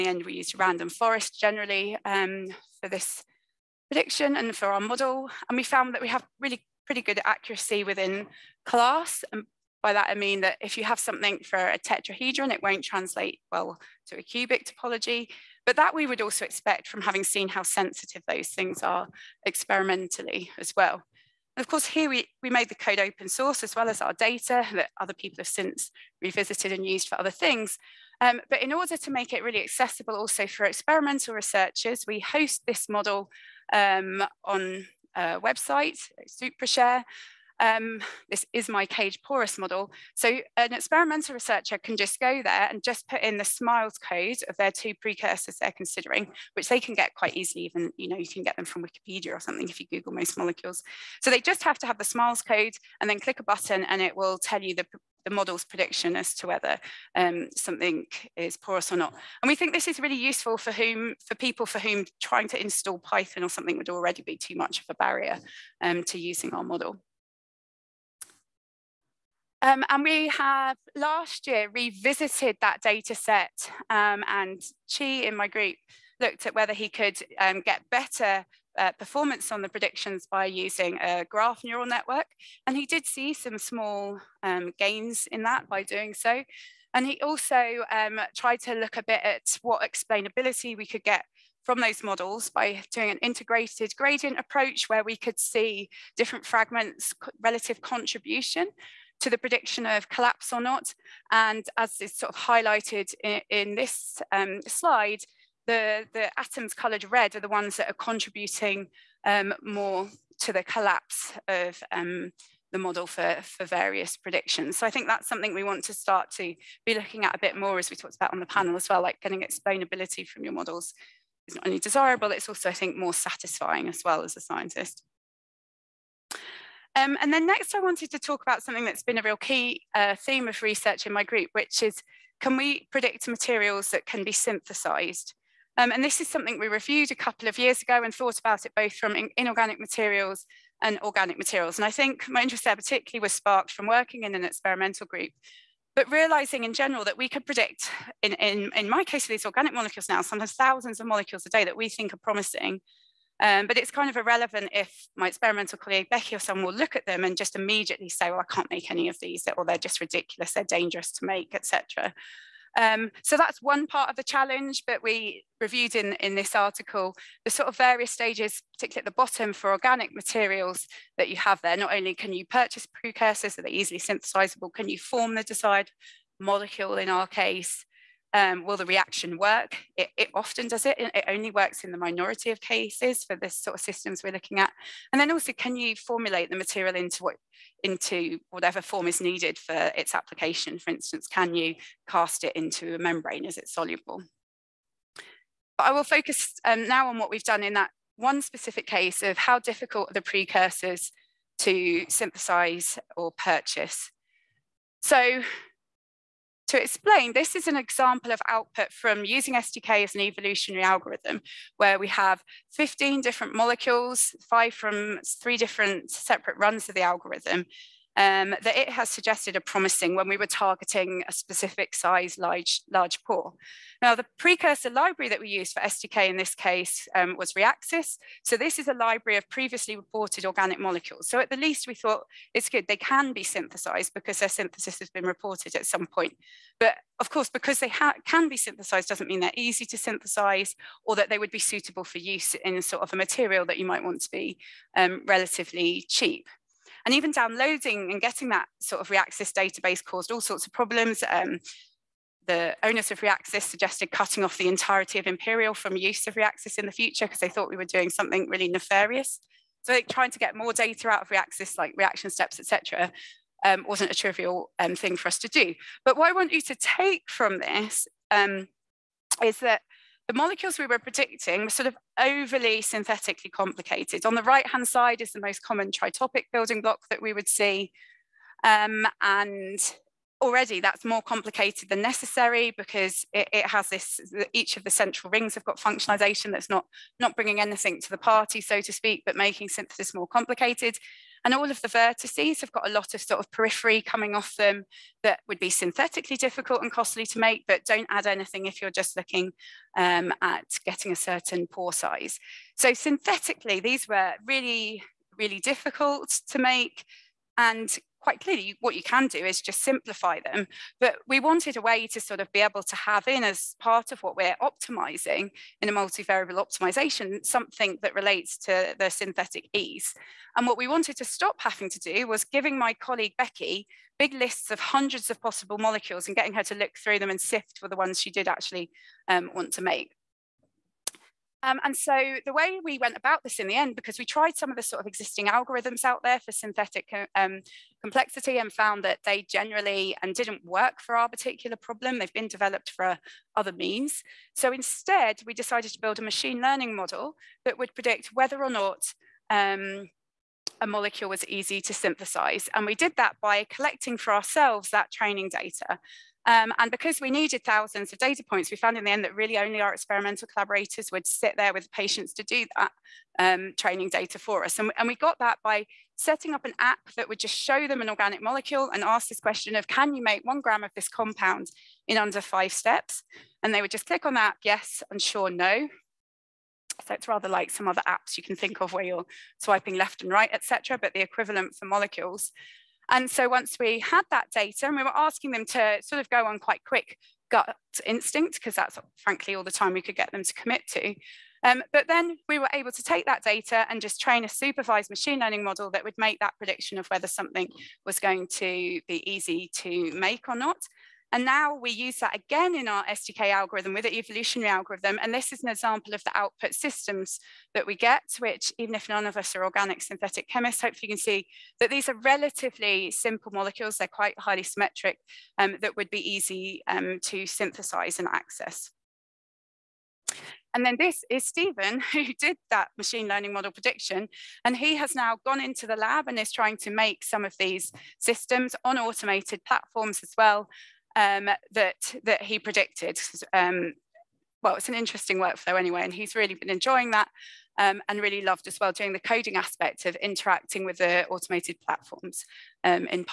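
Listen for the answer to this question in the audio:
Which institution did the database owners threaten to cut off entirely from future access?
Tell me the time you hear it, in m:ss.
4:15.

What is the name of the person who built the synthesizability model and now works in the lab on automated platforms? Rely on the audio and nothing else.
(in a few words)
Stephen.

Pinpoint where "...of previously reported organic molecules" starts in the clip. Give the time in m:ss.
3:49.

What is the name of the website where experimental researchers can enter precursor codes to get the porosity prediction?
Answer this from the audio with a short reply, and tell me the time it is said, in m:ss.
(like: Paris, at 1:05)
SupraShare, at 0:36.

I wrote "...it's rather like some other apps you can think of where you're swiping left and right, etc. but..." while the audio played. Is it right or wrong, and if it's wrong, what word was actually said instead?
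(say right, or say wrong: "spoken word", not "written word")
right.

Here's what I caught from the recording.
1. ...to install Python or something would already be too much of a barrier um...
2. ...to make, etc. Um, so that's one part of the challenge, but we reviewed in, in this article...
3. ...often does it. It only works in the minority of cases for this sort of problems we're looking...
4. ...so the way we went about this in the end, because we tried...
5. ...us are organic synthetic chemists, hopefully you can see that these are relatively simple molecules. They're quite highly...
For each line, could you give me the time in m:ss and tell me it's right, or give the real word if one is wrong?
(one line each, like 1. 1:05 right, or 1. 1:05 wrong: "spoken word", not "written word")
1. 1:02 right
2. 2:41 right
3. 3:00 wrong: "systems", not "problems"
4. 5:31 right
5. 6:49 right.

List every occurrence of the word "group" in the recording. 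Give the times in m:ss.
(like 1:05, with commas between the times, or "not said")
1:15, 2:11, 2:25.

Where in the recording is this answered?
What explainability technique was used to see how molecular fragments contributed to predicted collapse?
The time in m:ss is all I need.
1:33.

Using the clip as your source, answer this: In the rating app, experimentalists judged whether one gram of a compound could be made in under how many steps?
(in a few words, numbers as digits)
5.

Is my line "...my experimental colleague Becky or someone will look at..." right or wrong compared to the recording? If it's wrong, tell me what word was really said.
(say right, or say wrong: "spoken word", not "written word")
right.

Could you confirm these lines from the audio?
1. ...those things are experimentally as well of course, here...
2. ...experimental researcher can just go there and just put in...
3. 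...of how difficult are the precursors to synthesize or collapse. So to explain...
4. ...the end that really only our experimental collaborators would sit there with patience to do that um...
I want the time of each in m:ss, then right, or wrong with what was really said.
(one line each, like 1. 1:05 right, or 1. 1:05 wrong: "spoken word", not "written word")
1. 0:18 right
2. 0:40 right
3. 3:19 wrong: "purchase", not "collapse"
4. 5:59 right.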